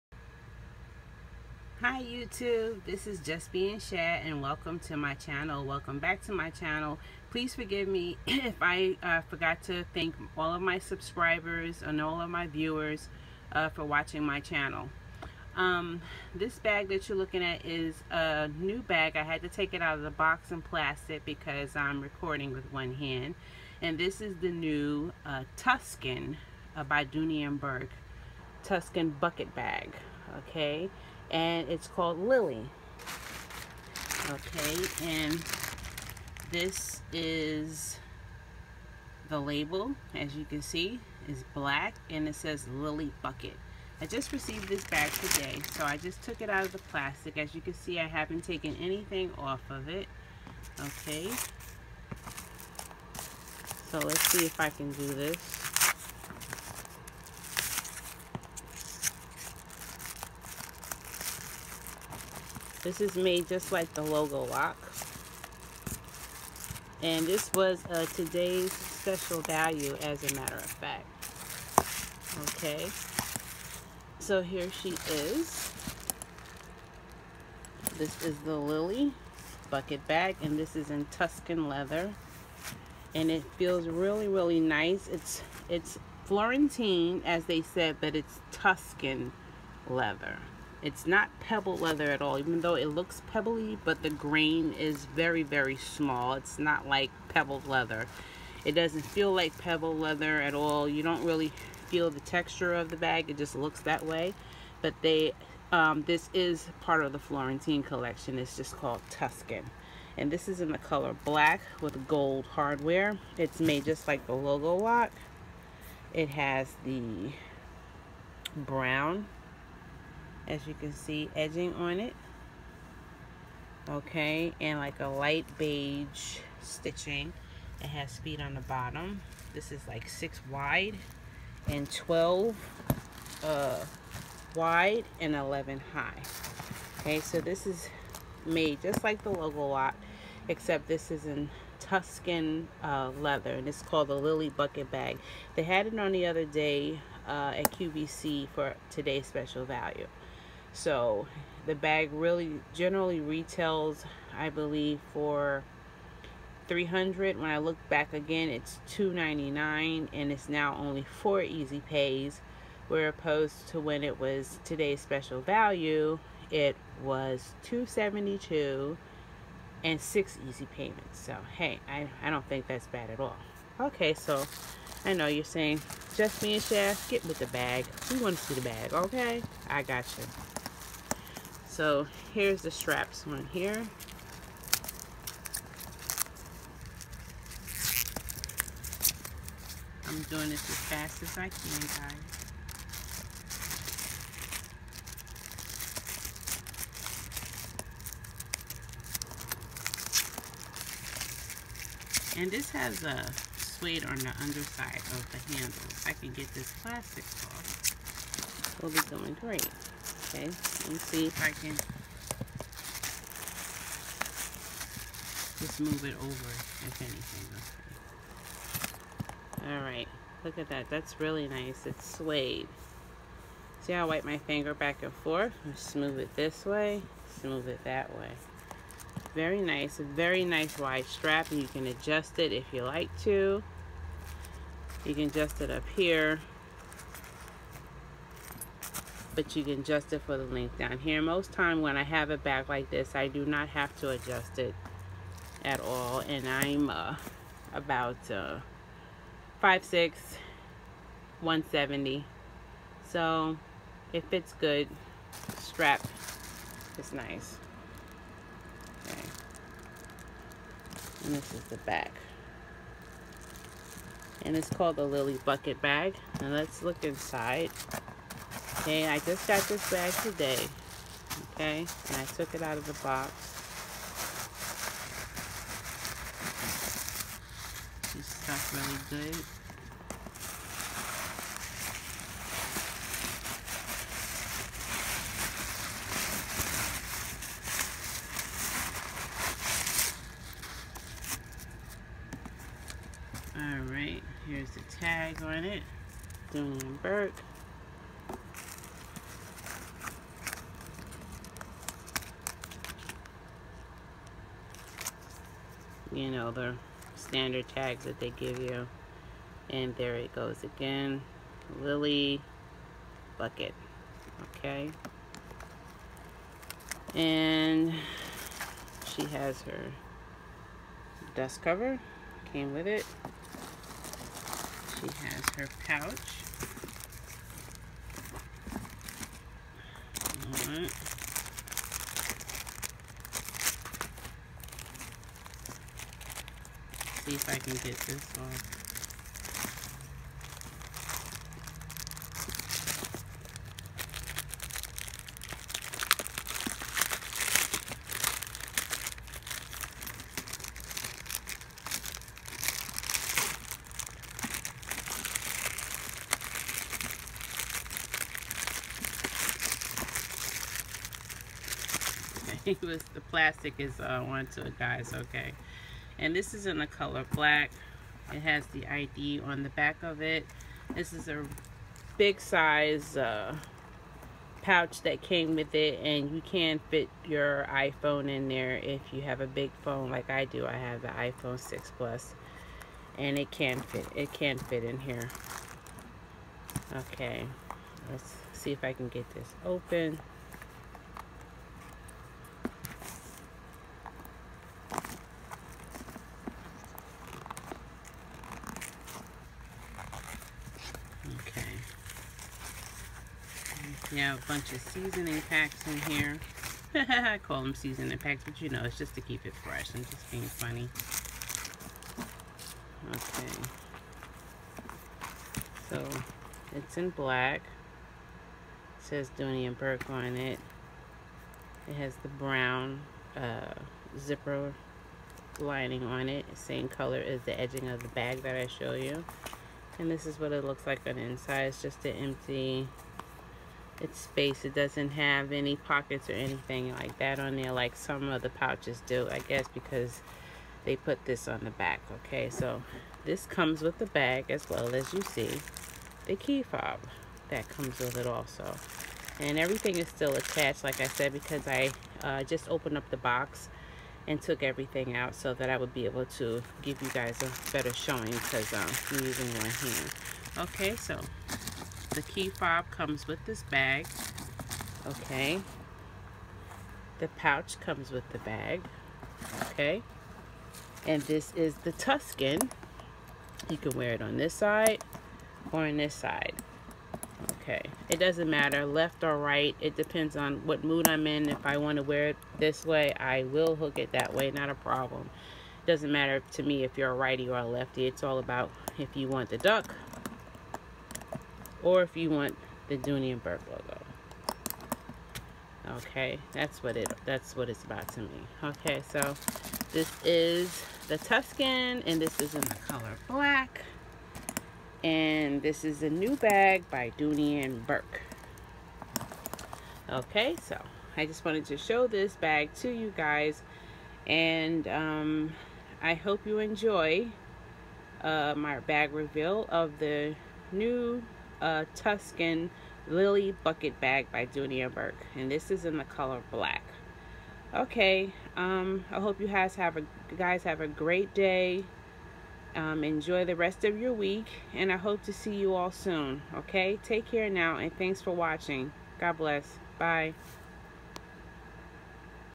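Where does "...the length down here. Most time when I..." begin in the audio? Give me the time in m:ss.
4:00.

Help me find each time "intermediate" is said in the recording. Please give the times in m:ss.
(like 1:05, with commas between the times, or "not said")
not said.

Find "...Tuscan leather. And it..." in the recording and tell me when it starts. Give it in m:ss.
1:21.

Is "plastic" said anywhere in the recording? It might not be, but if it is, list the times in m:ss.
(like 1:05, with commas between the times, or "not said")
0:20, 0:46, 3:26, 6:03.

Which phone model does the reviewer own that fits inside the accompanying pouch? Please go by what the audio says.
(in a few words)
iPhone 6 plus.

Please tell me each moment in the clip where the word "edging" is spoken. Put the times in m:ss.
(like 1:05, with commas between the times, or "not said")
2:01, 7:07.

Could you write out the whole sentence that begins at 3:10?
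I'm doing this as fast as I can, guys.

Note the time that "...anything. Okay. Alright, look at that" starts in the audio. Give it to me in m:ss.
3:37.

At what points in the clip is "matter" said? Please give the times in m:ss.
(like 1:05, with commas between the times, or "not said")
1:10, 7:58, 8:06.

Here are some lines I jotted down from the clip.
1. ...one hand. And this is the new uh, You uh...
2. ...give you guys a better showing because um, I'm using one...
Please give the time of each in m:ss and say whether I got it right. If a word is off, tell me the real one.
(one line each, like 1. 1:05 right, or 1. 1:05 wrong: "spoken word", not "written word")
1. 0:22 wrong: "Tuscan", not "You"
2. 7:36 right.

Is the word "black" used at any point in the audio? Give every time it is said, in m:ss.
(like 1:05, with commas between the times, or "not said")
0:41, 1:51, 6:07, 6:57, 8:23, 8:46.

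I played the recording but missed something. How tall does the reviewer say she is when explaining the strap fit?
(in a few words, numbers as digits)
5'6".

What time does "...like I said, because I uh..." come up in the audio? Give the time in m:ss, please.
7:30.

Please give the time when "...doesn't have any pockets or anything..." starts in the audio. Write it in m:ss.
7:14.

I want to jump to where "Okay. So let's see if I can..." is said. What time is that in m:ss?
0:50.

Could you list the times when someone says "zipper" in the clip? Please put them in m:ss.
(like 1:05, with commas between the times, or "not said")
7:04.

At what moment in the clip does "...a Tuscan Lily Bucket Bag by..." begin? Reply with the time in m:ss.
8:41.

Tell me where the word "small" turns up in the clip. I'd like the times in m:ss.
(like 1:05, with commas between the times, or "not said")
1:35.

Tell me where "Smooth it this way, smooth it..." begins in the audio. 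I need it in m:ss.
3:45.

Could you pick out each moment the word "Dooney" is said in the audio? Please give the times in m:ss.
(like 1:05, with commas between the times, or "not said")
0:27, 4:56, 6:59, 8:12, 8:27, 8:44.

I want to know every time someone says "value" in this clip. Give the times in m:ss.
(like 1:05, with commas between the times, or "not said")
1:09, 2:29, 2:45.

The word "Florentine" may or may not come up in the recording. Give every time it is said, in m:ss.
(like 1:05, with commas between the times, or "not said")
1:26, 1:47.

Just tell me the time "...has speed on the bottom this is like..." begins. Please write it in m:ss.
2:07.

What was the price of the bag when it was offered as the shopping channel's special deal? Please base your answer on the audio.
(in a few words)
272.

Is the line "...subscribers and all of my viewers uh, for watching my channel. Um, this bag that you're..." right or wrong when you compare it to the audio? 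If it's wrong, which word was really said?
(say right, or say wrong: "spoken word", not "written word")
right.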